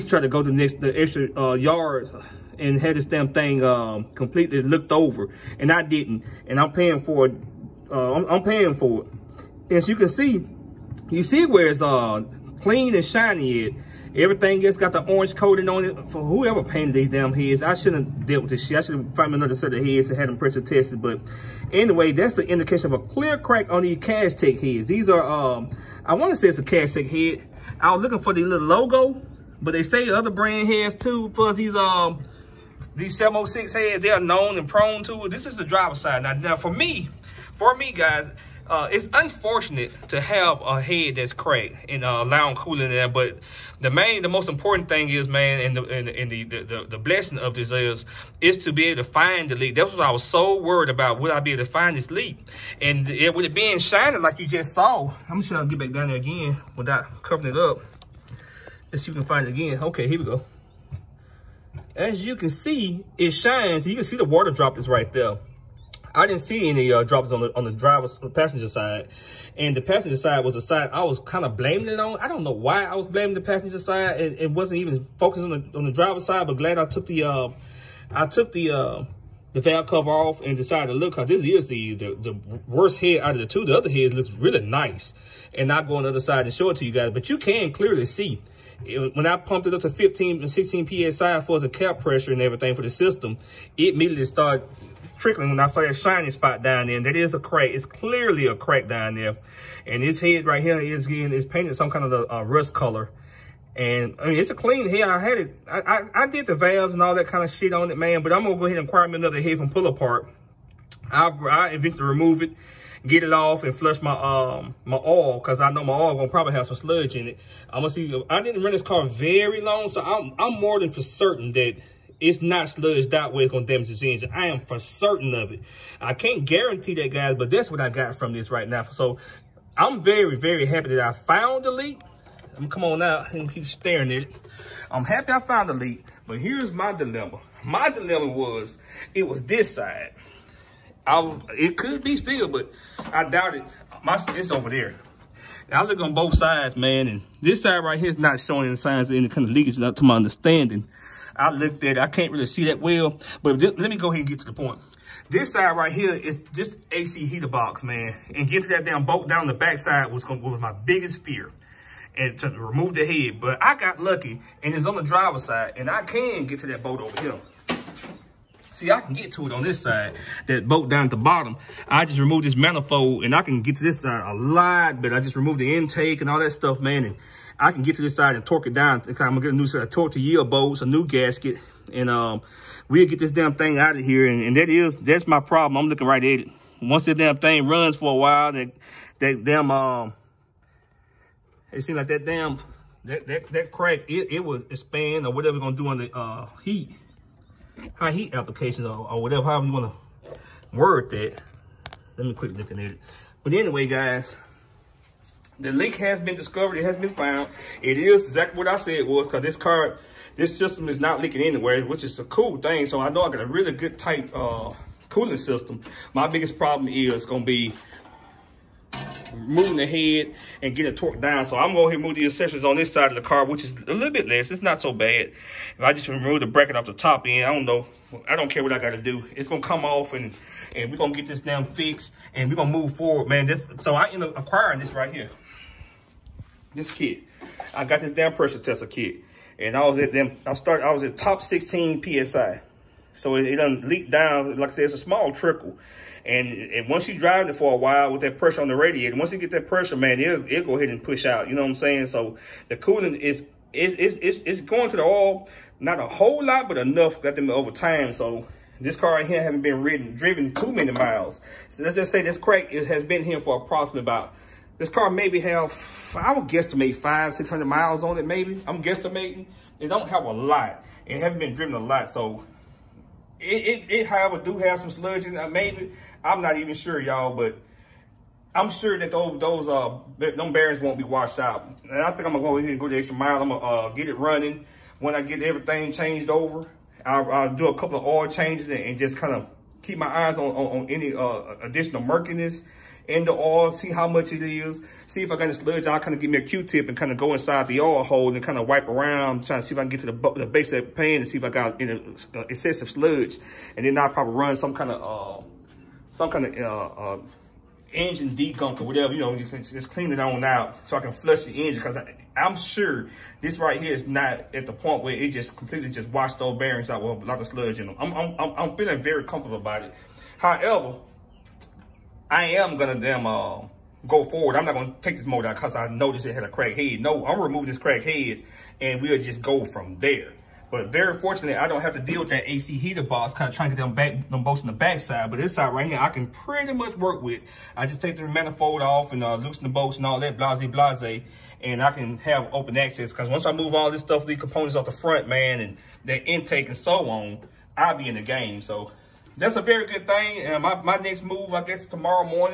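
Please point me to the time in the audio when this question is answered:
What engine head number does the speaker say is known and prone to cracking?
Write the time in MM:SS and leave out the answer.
00:33.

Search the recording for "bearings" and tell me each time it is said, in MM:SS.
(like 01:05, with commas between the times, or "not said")
04:40, 05:16.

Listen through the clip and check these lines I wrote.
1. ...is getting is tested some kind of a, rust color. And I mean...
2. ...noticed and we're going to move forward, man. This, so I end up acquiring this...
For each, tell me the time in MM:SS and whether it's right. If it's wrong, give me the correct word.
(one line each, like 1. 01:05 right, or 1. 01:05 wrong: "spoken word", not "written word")
1. 01:40 wrong: "painted", not "tested"
2. 03:51 wrong: "fixed", not "noticed".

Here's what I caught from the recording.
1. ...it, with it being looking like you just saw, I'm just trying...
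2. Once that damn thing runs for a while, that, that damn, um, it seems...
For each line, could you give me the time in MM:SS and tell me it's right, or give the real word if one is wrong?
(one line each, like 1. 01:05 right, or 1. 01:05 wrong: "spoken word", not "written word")
1. 00:53 wrong: "shining", not "looking"
2. 03:06 right.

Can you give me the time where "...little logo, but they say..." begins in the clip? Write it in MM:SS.
00:28.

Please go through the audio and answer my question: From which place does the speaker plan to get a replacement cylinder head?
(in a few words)
Pull-A-Part.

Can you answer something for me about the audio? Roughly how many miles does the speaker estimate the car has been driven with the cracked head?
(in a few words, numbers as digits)
500-600 miles.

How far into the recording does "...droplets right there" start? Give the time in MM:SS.
01:04.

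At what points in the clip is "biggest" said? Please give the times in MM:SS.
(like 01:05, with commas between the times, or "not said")
02:40, 03:36.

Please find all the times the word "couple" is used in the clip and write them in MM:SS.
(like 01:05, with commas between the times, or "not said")
04:47.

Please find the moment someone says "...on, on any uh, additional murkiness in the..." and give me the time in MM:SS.
04:50.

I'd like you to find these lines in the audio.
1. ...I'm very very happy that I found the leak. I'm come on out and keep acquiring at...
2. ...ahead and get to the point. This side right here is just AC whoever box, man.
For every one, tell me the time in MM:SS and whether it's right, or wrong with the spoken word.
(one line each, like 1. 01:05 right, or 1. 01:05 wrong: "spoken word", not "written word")
1. 02:09 wrong: "staring", not "acquiring"
2. 02:34 wrong: "heater", not "whoever".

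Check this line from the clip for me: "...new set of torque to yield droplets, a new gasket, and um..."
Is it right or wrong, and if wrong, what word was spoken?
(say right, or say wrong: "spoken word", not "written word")
wrong: "bolts", not "droplets".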